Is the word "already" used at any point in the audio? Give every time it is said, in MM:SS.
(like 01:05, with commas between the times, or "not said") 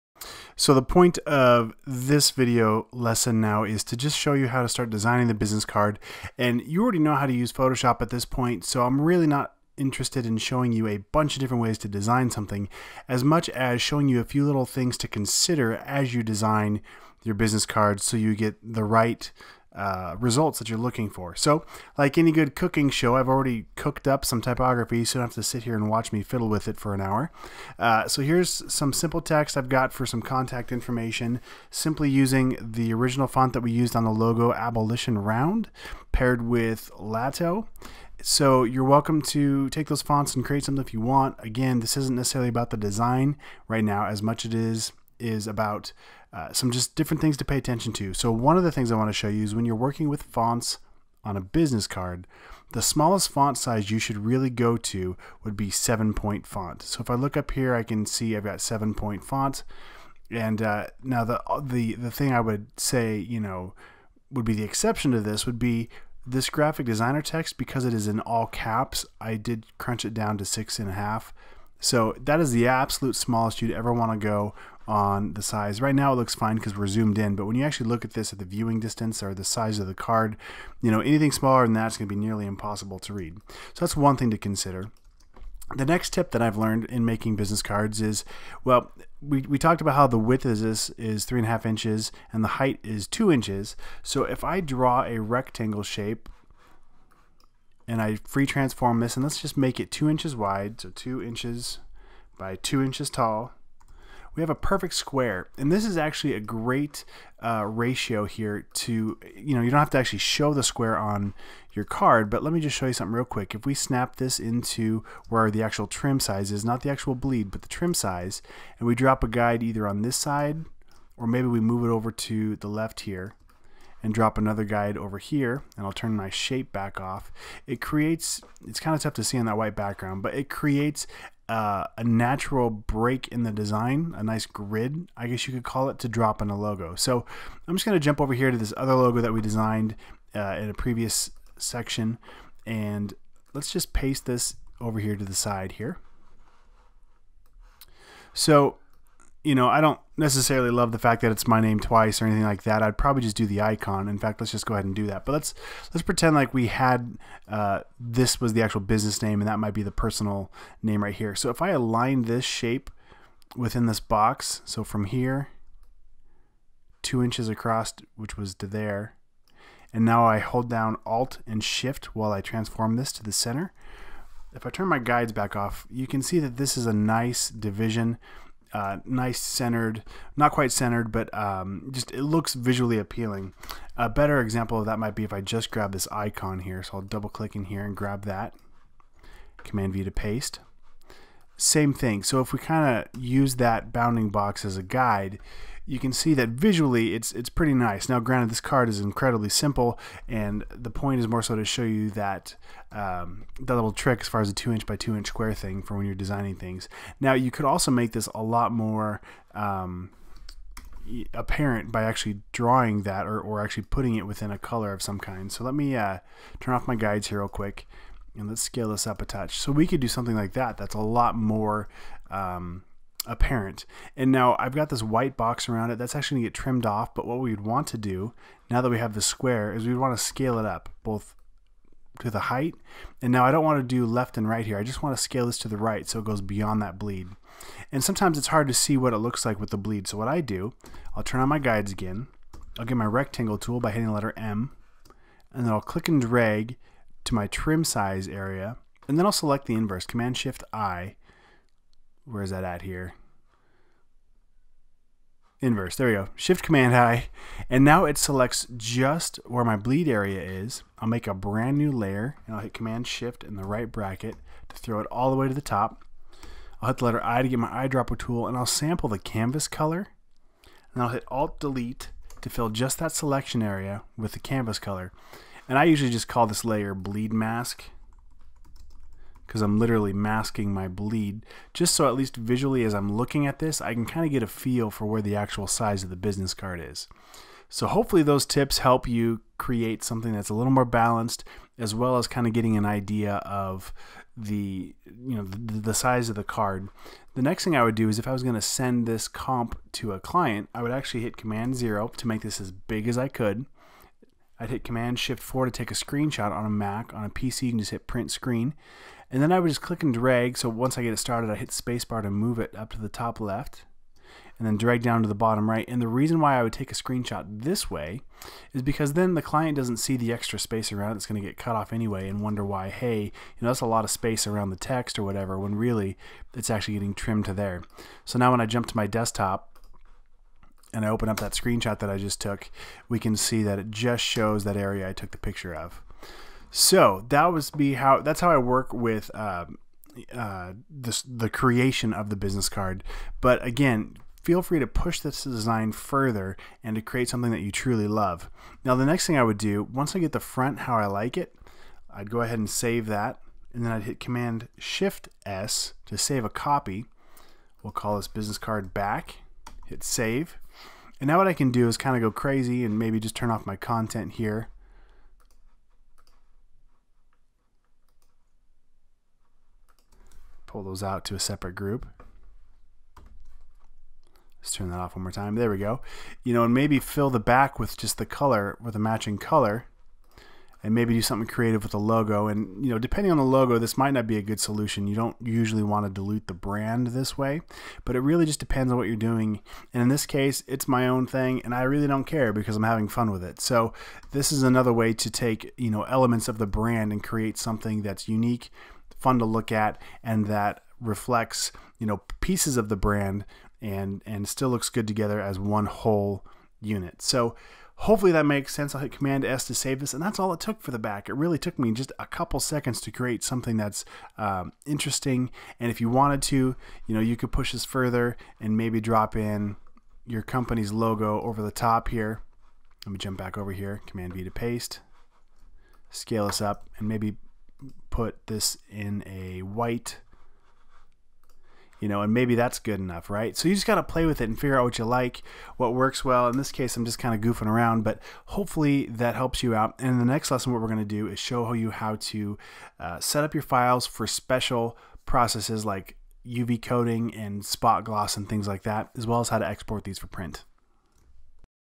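00:06, 00:23.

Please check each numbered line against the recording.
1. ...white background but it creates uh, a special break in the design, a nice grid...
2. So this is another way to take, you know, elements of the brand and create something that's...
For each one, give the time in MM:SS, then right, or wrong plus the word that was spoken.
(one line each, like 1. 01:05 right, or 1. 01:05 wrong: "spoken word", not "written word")
1. 02:09 wrong: "natural", not "special"
2. 06:33 right.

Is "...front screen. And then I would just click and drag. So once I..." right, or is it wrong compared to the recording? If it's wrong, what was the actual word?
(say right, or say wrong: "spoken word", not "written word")
wrong: "print", not "front".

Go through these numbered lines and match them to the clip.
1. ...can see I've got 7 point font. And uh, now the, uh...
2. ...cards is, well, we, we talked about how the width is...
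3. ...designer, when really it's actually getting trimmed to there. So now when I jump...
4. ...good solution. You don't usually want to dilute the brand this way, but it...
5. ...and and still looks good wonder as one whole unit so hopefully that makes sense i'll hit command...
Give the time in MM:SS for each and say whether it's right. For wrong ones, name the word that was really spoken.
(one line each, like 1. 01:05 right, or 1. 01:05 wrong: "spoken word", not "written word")
1. 00:57 right
2. 01:27 right
3. 05:25 wrong: "whatever", not "designer"
4. 06:24 right
5. 06:43 wrong: "together", not "wonder".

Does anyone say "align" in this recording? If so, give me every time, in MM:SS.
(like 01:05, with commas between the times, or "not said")
02:41.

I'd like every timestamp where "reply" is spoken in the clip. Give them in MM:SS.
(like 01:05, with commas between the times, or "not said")
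not said.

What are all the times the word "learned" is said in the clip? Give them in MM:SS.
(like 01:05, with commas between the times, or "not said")
01:26.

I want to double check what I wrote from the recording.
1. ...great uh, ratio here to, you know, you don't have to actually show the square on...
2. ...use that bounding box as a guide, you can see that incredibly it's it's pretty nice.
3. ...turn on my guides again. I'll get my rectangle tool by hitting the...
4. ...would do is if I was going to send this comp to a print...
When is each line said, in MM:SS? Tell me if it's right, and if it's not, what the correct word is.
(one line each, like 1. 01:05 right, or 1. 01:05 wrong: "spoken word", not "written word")
1. 01:46 right
2. 03:13 wrong: "visually", not "incredibly"
3. 04:01 right
4. 04:57 wrong: "client", not "print".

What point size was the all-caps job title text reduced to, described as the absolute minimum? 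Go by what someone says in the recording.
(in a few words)
6.5.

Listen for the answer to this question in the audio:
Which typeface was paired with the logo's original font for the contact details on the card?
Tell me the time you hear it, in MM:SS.
00:36.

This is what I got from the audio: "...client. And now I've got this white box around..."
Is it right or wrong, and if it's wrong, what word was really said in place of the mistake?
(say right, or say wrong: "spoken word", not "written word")
wrong: "apparent", not "client".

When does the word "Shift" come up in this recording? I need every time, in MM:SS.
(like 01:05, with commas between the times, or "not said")
02:51, 04:10, 04:16, 04:23, 05:05, 05:54.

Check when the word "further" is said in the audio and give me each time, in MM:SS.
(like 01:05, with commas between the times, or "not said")
05:45, 06:57.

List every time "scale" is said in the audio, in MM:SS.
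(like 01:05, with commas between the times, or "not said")
03:38, 03:50, 03:55, 07:06.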